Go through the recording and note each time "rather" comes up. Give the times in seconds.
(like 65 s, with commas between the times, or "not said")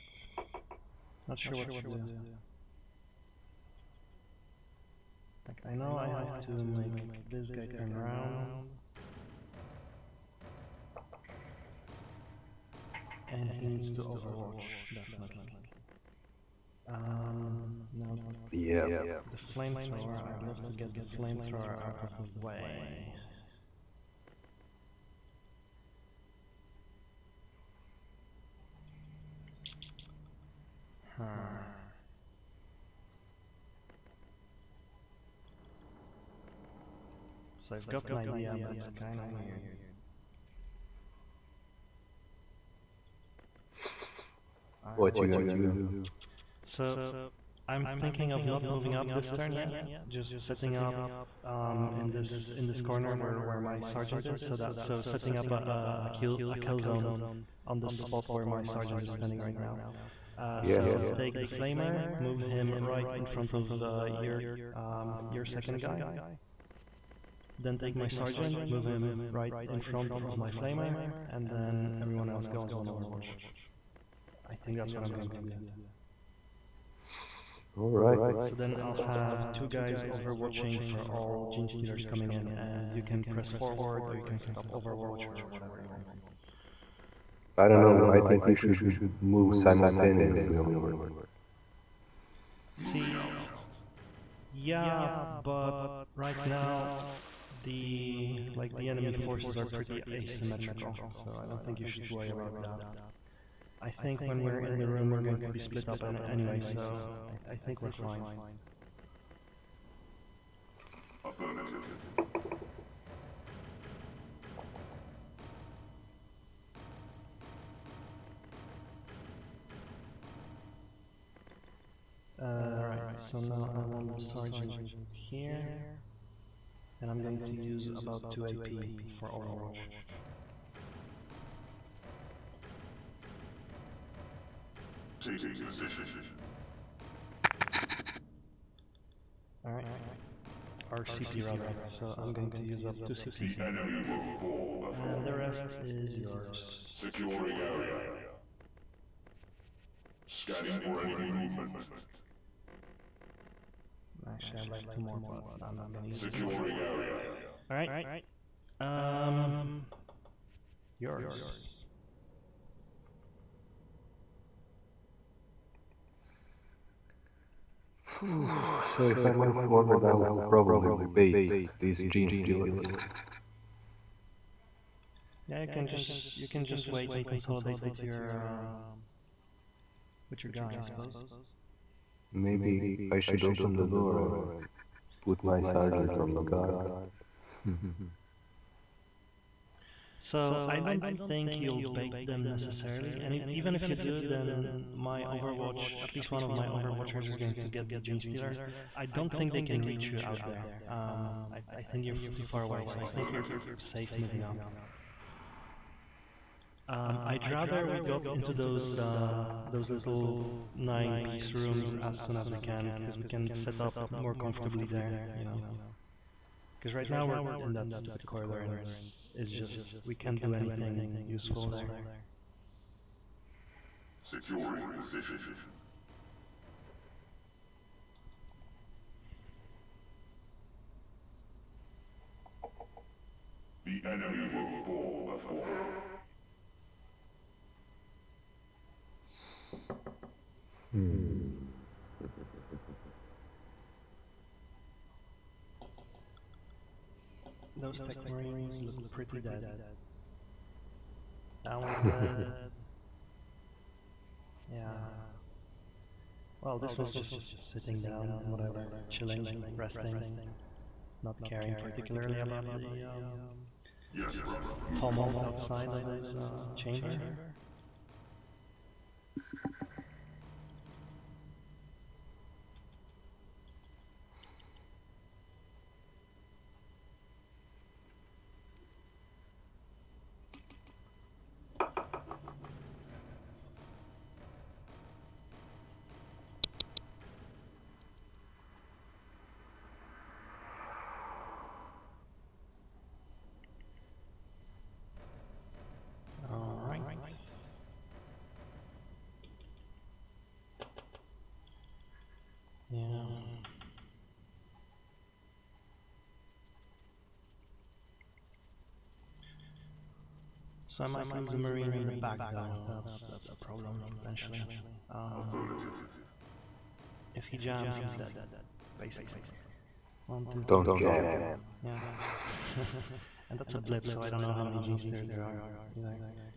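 141 s, 207 s.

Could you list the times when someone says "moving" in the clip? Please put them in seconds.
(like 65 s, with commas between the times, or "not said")
48 s, 204 s.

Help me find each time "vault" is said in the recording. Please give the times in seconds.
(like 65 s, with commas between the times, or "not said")
not said.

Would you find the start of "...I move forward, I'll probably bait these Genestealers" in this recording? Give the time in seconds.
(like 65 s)
169 s.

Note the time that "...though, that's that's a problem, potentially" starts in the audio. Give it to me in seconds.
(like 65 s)
312 s.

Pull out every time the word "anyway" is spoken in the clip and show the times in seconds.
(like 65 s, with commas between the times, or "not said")
106 s.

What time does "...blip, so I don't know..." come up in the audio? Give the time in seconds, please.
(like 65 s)
323 s.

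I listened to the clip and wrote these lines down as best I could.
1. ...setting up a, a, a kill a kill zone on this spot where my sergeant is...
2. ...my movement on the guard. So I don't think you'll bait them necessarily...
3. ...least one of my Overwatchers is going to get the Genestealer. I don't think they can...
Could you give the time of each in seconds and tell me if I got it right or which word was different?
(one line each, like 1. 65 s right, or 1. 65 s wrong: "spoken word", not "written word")
1. 55 s right
2. 185 s wrong: "sergeant", not "movement"
3. 196 s right.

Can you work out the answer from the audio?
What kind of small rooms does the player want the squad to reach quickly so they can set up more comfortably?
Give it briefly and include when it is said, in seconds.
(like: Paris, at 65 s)
Nine-piece rooms, at 210 s.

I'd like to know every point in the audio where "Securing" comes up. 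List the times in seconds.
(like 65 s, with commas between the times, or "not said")
146 s, 156 s, 224 s.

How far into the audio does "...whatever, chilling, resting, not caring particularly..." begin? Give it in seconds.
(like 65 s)
258 s.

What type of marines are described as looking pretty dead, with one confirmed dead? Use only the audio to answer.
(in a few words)
Tech marines.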